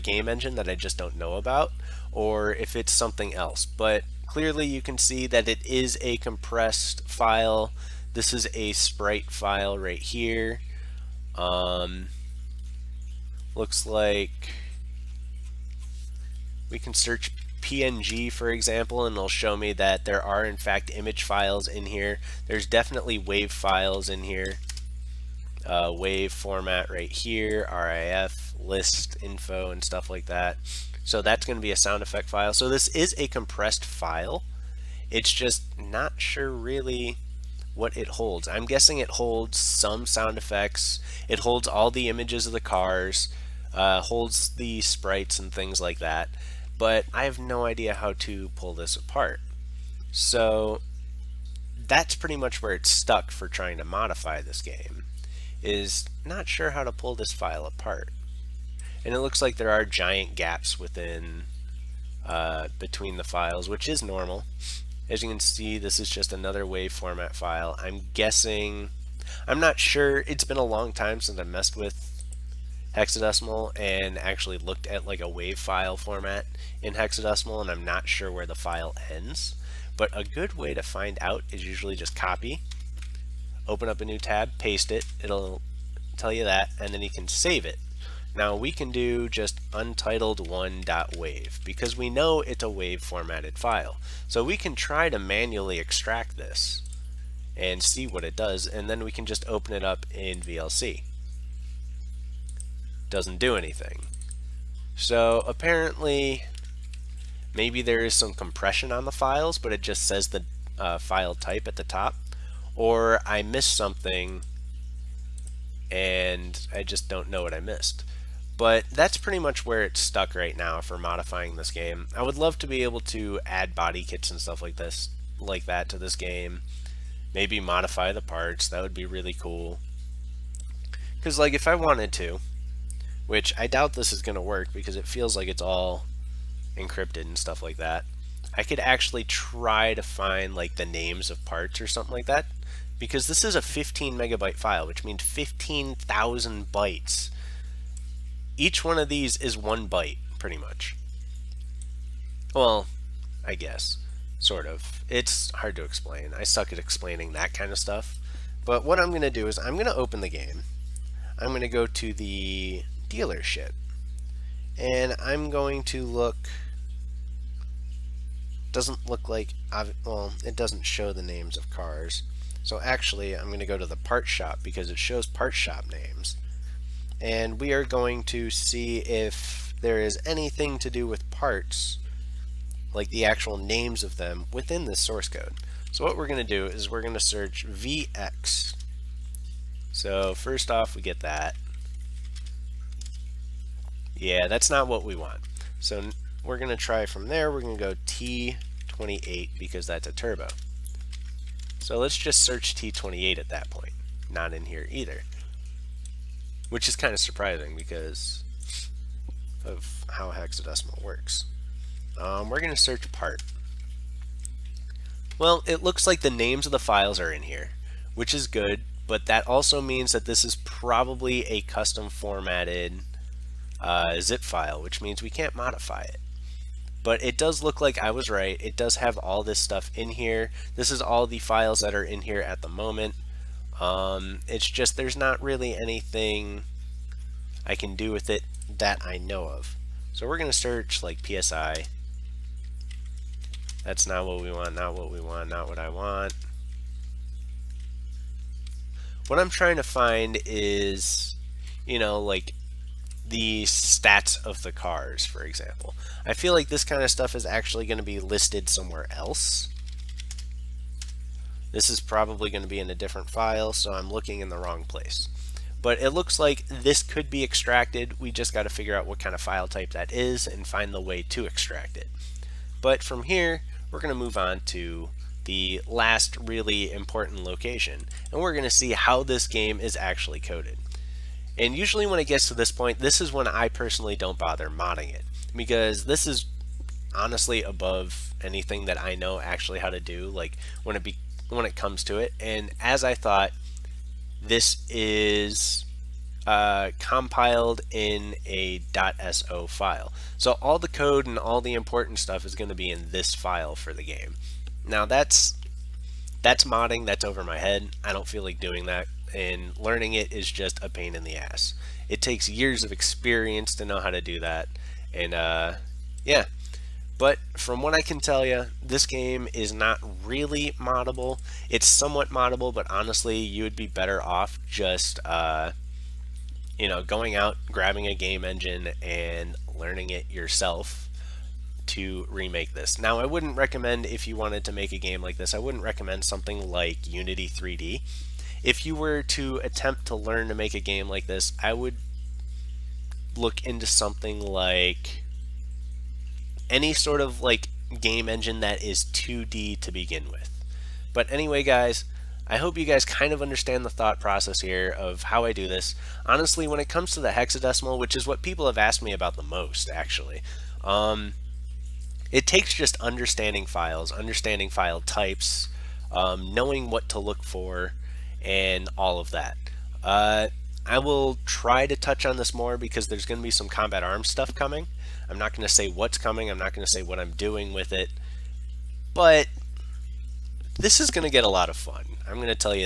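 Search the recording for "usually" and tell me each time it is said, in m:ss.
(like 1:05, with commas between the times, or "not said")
1:21, 4:41.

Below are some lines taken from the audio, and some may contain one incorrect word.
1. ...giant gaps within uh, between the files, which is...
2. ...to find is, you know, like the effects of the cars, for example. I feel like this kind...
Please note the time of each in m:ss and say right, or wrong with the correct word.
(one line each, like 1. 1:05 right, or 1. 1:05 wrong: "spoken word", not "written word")
1. 0:59 right
2. 4:09 wrong: "stats", not "effects".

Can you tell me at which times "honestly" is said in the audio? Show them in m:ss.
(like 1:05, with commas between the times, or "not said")
4:47, 5:22, 5:56.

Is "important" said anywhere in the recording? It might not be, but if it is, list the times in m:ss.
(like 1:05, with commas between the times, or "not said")
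4:36, 5:01.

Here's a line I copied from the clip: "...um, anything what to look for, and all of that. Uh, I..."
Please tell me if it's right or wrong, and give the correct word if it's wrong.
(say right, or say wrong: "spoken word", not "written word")
wrong: "knowing", not "anything".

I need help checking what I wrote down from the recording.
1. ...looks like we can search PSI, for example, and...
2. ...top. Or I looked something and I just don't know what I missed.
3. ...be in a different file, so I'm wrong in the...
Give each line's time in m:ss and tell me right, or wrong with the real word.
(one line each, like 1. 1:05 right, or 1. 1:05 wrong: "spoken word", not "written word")
1. 0:13 wrong: "PNG", not "PSI"
2. 1:51 wrong: "missed", not "looked"
3. 4:22 wrong: "looking", not "wrong".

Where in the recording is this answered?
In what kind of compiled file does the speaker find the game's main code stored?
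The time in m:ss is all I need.
4:59.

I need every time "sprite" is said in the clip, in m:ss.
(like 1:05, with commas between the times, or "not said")
0:08, 0:44.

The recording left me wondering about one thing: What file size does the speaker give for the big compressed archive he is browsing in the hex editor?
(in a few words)
15 megabytes.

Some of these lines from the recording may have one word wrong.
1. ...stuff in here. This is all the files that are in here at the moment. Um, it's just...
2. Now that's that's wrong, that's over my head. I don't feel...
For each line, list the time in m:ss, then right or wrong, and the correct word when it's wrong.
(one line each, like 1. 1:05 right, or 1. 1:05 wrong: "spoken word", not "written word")
1. 3:49 right
2. 5:04 wrong: "modding", not "wrong".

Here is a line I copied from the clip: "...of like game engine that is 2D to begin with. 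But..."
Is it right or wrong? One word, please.
right.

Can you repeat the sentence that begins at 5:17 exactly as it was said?
But from what I can tell you, this game is not really moddable.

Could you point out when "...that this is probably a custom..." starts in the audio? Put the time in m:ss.
3:40.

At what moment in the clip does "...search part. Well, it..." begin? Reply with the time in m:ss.
3:32.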